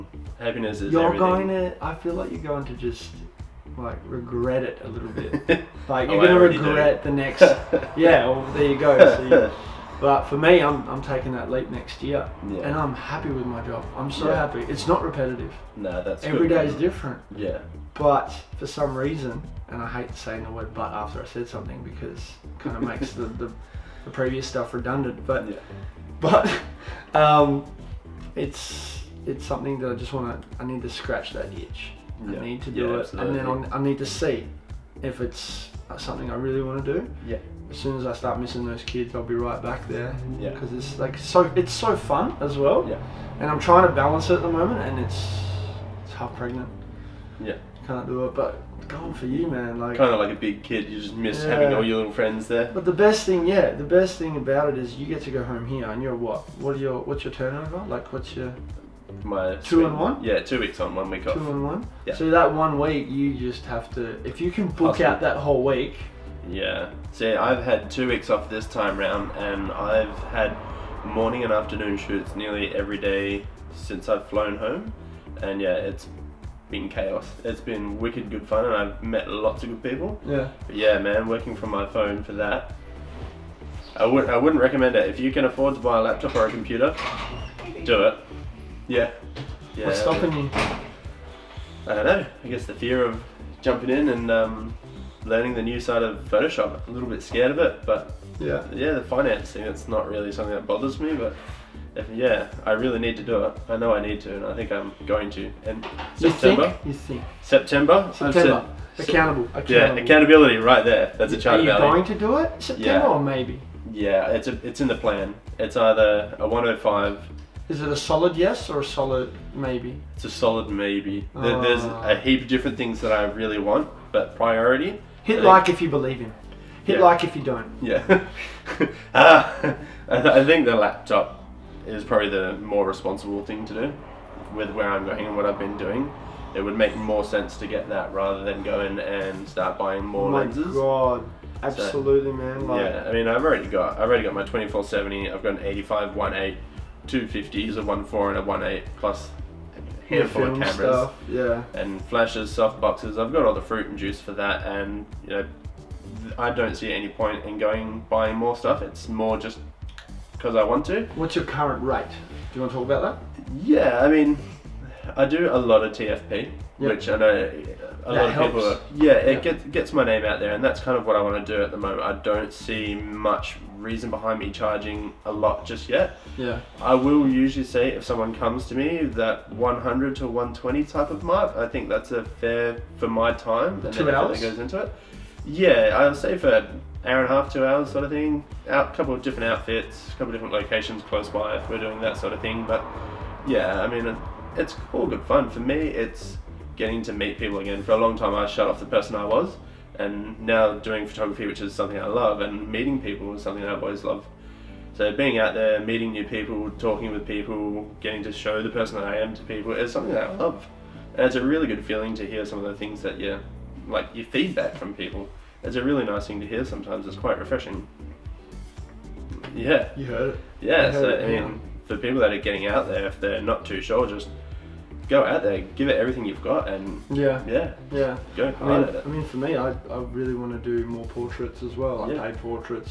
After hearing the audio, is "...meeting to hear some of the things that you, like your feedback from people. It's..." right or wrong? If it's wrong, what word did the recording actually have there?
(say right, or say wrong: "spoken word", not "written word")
wrong: "feeling", not "meeting".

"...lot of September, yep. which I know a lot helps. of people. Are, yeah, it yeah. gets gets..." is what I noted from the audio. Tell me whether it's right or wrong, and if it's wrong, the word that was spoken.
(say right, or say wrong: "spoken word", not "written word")
wrong: "TFP", not "September".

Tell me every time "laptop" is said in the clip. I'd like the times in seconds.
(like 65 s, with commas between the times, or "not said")
86 s, 130 s.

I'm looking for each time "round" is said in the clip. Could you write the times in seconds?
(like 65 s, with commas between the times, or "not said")
68 s.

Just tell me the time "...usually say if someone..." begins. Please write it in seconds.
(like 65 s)
177 s.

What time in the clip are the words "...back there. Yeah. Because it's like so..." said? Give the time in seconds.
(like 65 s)
39 s.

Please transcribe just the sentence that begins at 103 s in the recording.
I know I need to, and I think I'm going to.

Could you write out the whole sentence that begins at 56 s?
What are your what's your turnover?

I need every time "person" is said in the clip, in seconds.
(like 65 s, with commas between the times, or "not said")
198 s, 208 s.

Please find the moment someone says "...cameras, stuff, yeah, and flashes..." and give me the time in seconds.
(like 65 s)
150 s.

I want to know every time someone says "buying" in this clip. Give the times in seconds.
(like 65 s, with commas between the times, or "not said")
139 s, 158 s.